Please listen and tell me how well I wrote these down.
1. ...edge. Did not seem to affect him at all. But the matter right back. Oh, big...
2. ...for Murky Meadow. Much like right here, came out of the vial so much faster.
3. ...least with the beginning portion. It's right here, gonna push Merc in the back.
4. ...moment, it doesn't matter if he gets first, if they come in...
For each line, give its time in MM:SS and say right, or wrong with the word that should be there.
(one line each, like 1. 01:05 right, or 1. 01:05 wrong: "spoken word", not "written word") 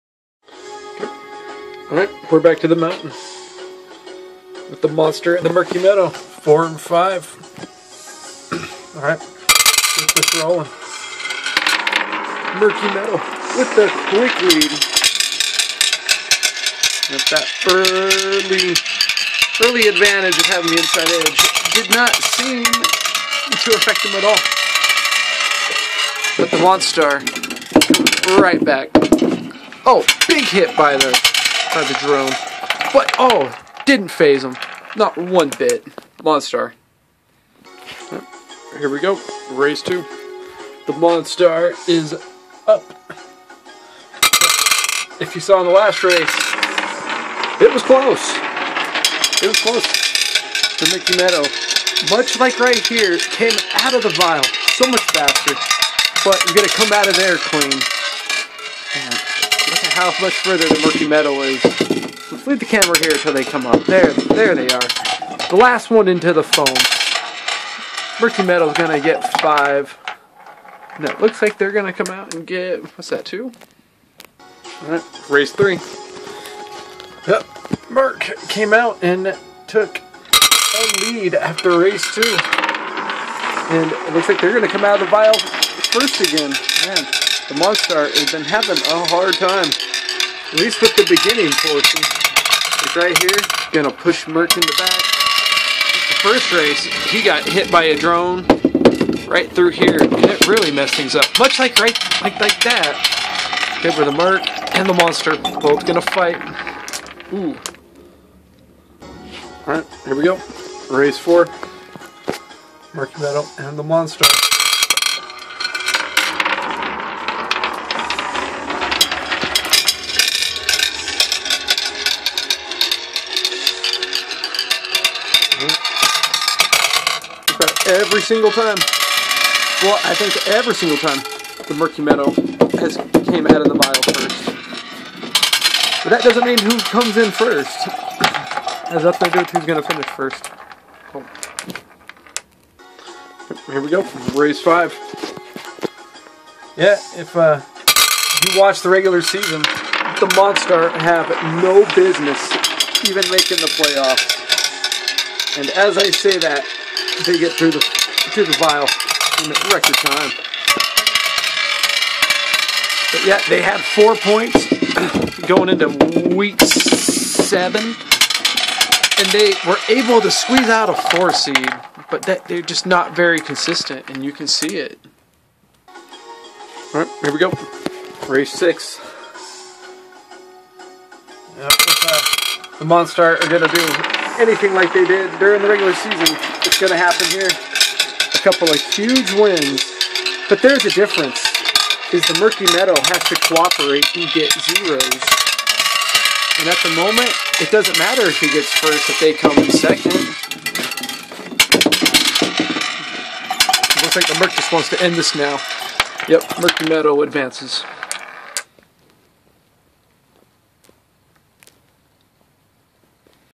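1. 00:21 wrong: "monster", not "matter"
2. 00:49 right
3. 01:30 right
4. 03:16 right.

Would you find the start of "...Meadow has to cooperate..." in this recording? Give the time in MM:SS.
03:12.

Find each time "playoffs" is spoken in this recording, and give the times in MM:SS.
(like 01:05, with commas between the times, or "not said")
02:33.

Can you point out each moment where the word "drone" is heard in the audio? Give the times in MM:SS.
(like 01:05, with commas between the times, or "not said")
00:31, 01:37.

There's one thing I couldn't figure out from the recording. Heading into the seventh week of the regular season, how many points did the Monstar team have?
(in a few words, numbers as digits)
4.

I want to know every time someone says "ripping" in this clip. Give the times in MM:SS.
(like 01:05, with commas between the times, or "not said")
not said.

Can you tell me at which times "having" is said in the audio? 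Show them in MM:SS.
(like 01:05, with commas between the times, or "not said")
00:20, 01:28.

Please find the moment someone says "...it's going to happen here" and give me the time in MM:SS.
03:06.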